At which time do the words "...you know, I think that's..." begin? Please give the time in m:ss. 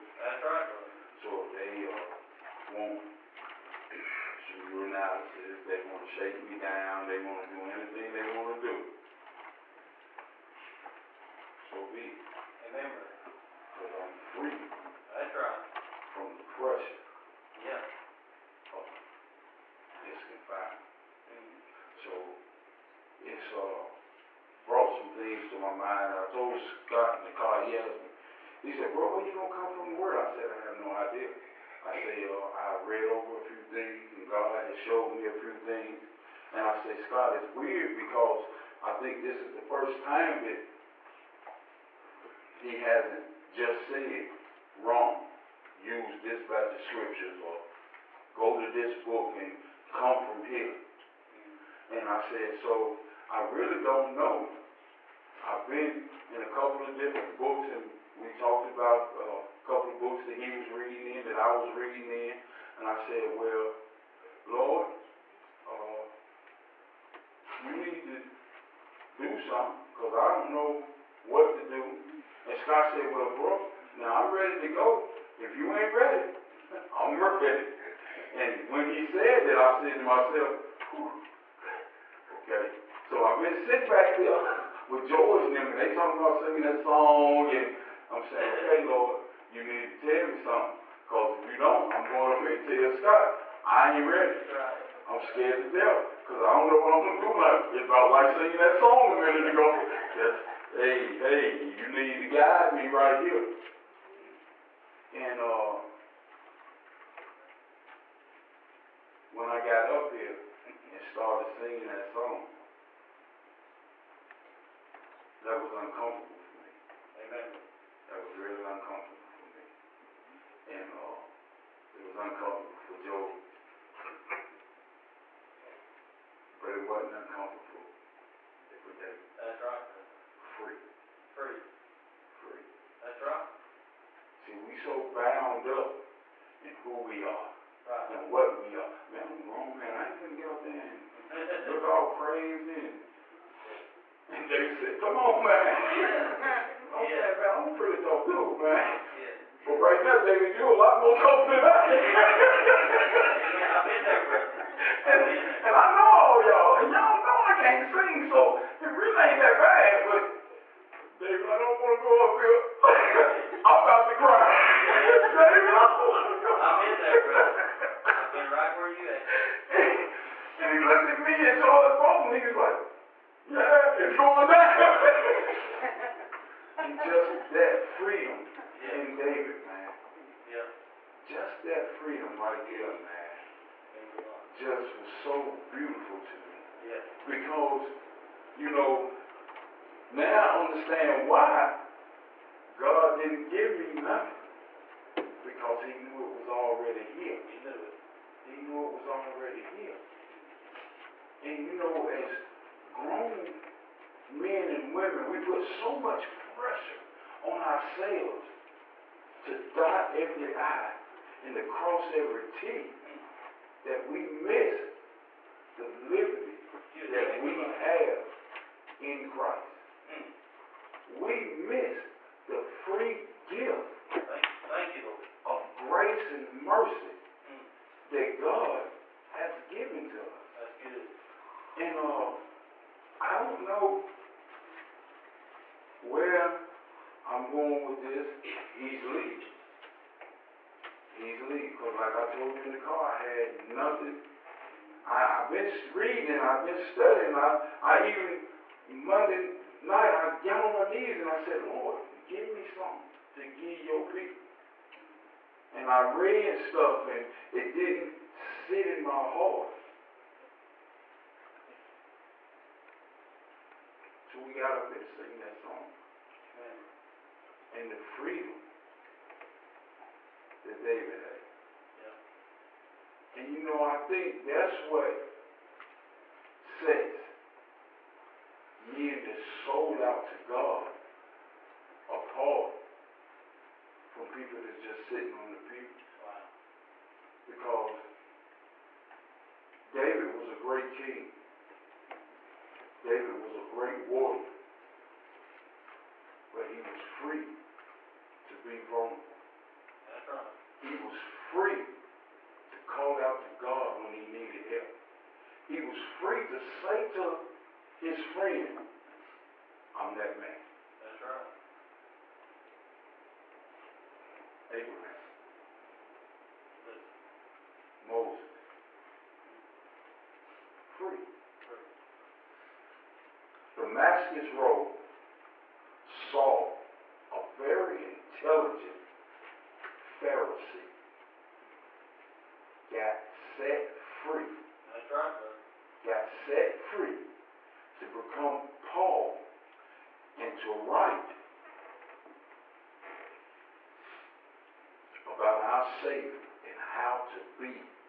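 4:33.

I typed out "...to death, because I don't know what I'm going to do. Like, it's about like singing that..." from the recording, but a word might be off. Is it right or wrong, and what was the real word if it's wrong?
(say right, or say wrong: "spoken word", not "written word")
right.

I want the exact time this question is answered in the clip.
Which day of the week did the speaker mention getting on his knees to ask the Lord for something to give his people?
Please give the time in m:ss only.
4:08.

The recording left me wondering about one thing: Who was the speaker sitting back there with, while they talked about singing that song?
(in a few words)
George.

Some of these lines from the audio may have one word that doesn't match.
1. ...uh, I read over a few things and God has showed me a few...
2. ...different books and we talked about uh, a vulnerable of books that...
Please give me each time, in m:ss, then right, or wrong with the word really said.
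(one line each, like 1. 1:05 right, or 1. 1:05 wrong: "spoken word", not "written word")
1. 0:32 right
2. 0:56 wrong: "couple", not "vulnerable".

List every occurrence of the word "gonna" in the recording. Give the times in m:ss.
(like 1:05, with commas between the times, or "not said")
0:29, 2:20.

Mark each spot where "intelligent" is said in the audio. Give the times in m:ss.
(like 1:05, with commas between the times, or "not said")
5:28.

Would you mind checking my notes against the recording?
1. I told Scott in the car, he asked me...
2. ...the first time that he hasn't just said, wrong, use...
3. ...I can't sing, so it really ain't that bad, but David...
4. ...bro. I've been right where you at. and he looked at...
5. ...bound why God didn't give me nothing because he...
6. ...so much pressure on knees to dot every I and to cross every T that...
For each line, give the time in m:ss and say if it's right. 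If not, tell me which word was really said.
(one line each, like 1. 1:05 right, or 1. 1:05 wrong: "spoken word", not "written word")
1. 0:26 right
2. 0:39 right
3. 2:37 right
4. 2:47 right
5. 3:10 wrong: "understand", not "bound"
6. 3:25 wrong: "ourselves", not "knees".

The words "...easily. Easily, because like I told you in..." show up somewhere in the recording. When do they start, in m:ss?
3:58.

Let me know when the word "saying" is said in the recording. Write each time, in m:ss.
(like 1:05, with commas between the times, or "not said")
1:28, 2:27.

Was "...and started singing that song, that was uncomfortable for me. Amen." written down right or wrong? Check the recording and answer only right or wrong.
right.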